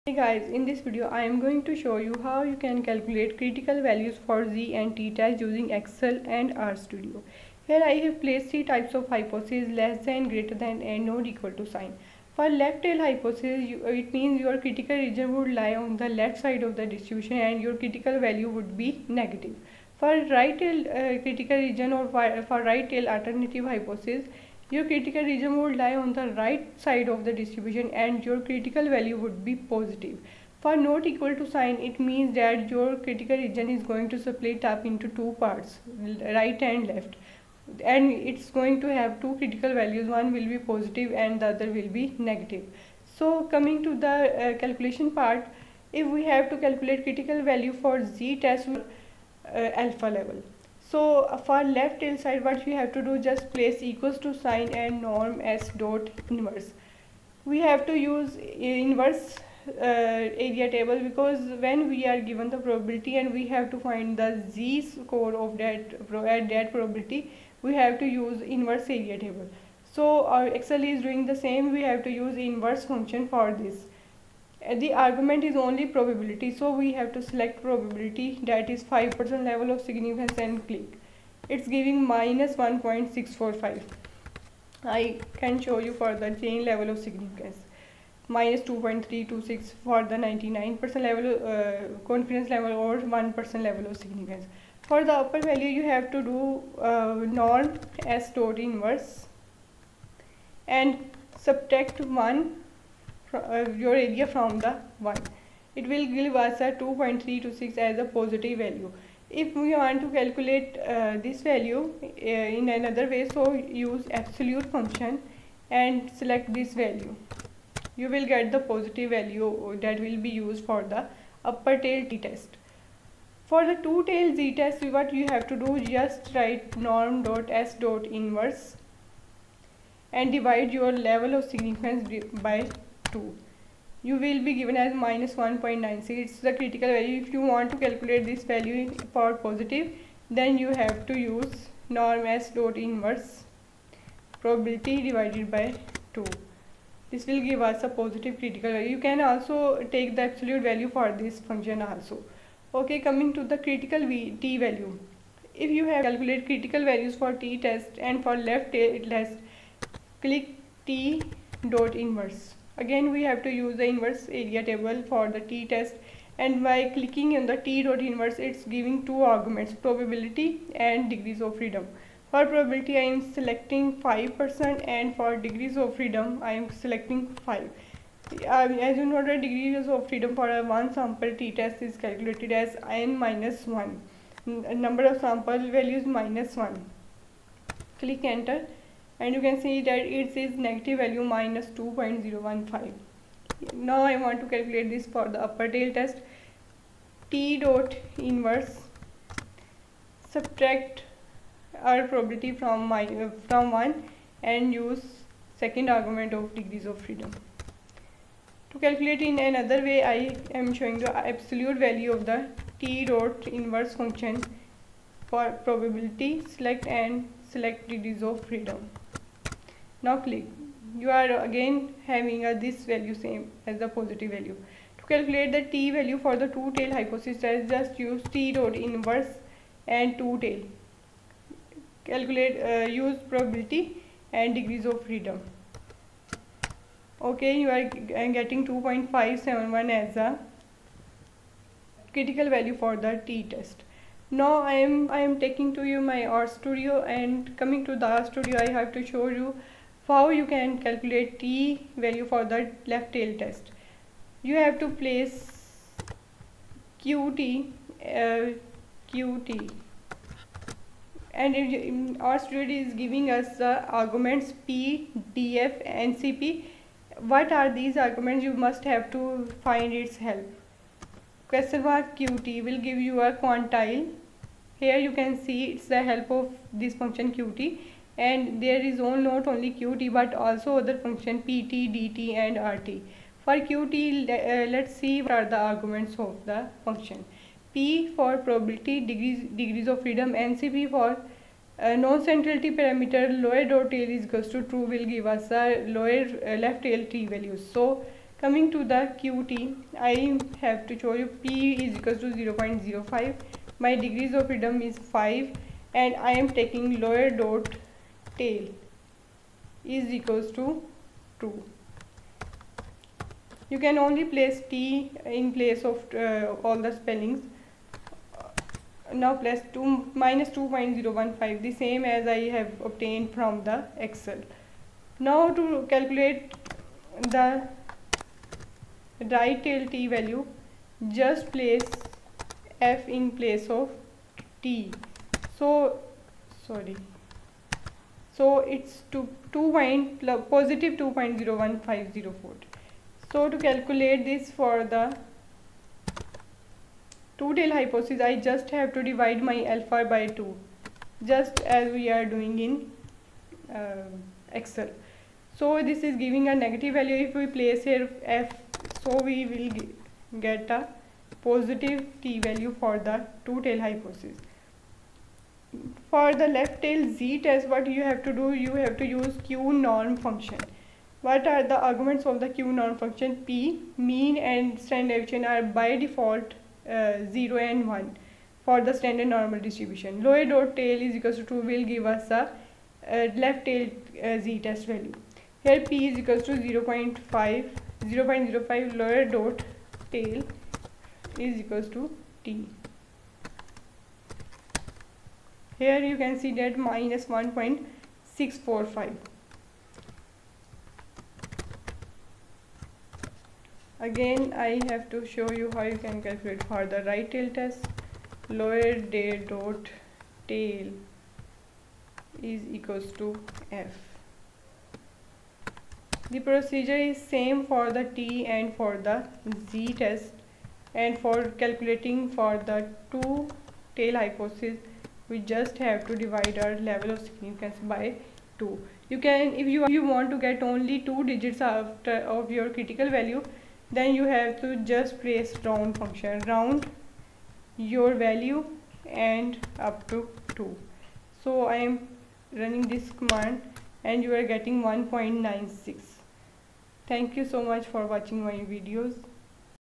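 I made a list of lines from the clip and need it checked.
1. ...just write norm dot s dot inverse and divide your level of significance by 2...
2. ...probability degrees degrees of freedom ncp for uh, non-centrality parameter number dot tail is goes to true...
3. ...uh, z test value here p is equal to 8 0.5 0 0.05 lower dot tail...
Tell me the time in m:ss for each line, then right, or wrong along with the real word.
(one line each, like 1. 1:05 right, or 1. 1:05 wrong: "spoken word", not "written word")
1. 2:05 right
2. 4:48 wrong: "lower", not "number"
3. 6:23 wrong: "0", not "8".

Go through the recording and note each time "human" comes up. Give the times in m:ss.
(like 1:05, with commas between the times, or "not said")
not said.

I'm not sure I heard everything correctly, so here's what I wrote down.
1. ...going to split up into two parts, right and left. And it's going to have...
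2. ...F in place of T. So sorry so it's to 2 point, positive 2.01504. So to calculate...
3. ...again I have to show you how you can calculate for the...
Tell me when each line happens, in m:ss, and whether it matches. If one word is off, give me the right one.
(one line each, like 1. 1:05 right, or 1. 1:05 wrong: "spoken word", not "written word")
1. 0:33 right
2. 5:32 right
3. 6:44 right.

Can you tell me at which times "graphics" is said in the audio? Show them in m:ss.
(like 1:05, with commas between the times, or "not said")
not said.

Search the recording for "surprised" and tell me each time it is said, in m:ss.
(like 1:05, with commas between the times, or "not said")
not said.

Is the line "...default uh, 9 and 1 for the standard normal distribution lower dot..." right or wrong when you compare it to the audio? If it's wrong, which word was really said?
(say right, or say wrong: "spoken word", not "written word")
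wrong: "0", not "9".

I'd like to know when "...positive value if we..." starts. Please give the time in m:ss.
1:48.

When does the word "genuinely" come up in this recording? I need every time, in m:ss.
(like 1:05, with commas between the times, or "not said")
not said.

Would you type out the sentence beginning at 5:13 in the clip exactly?
You can only place T in place of uh, all the spellings.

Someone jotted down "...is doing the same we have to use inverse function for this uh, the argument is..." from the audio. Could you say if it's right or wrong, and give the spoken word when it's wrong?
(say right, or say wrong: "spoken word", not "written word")
right.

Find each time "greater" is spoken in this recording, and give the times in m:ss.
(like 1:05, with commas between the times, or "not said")
0:10.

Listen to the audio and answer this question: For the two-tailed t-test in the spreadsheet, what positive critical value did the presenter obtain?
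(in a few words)
2.571.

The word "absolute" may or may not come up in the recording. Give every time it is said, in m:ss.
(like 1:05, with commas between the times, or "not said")
1:54, 2:30, 3:31.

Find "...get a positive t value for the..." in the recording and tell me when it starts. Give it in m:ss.
6:00.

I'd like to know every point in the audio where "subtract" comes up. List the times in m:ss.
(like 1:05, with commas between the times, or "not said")
1:41, 3:20.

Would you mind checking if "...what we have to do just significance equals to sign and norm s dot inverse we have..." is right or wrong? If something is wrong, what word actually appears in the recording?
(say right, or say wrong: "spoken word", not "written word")
wrong: "place", not "significance".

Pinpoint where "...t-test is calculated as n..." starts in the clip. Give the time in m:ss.
3:01.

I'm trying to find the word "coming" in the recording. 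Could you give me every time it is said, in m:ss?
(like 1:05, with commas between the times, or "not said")
0:43, 2:33, 4:07, 4:58.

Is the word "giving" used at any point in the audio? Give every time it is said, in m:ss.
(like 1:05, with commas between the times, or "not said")
1:21, 2:48, 4:23, 5:56.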